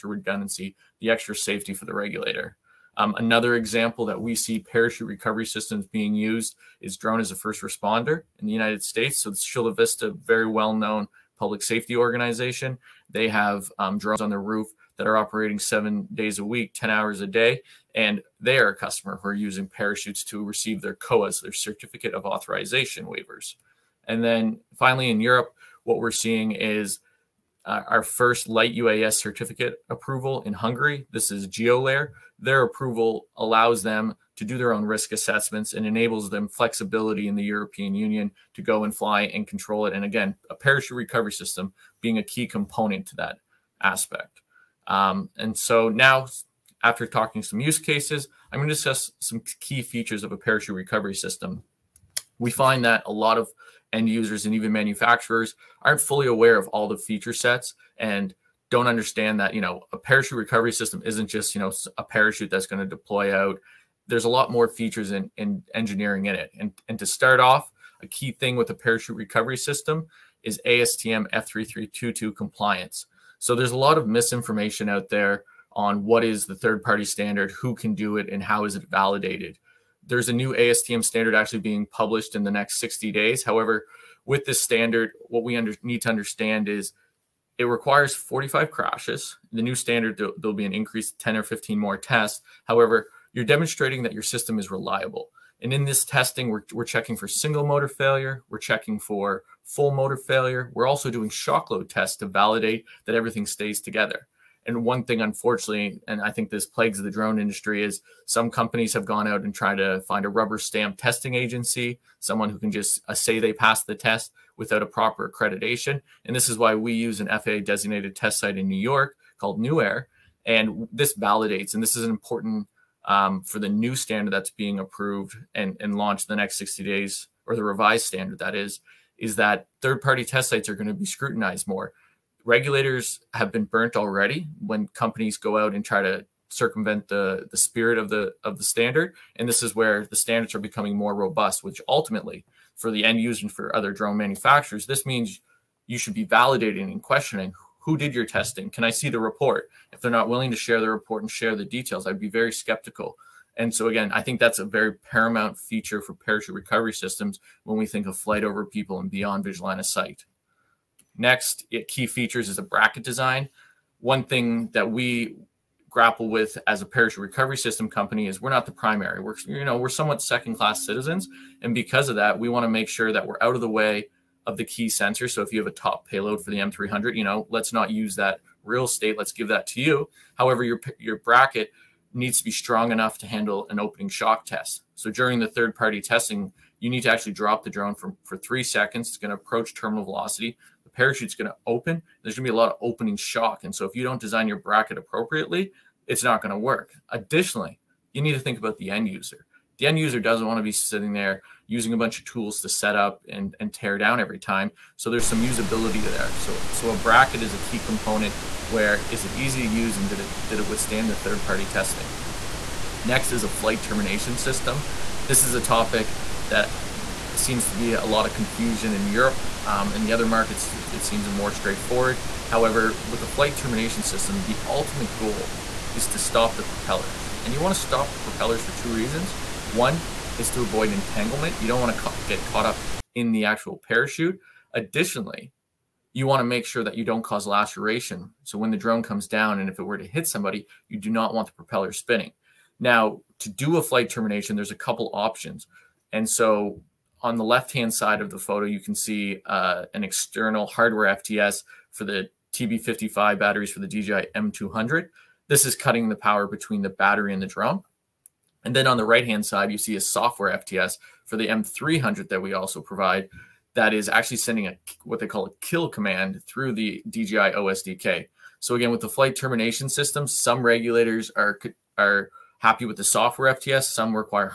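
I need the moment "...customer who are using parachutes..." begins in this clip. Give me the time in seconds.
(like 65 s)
18 s.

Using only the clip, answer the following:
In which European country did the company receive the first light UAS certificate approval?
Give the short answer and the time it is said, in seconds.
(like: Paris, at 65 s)
Hungary, at 30 s.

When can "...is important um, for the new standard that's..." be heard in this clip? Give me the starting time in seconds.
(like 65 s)
121 s.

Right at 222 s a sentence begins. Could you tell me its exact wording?
However, with the flight termination system, the ultimate goal is to stop the propellers.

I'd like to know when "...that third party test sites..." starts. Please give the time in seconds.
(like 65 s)
129 s.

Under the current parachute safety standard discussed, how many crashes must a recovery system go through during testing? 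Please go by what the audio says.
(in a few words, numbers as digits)
45.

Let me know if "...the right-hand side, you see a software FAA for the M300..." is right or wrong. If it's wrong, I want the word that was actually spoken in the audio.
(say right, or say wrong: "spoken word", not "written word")
wrong: "FTS", not "FAA".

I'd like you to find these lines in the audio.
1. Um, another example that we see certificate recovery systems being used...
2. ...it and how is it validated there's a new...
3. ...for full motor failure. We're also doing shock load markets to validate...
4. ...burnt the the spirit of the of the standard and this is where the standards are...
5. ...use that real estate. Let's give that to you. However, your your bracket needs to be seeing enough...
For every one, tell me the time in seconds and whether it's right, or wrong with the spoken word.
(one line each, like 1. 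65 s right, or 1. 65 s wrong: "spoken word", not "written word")
1. 2 s wrong: "parachute", not "certificate"
2. 78 s right
3. 98 s wrong: "tests", not "markets"
4. 136 s wrong: "circumvent", not "burnt"
5. 177 s wrong: "strong", not "seeing".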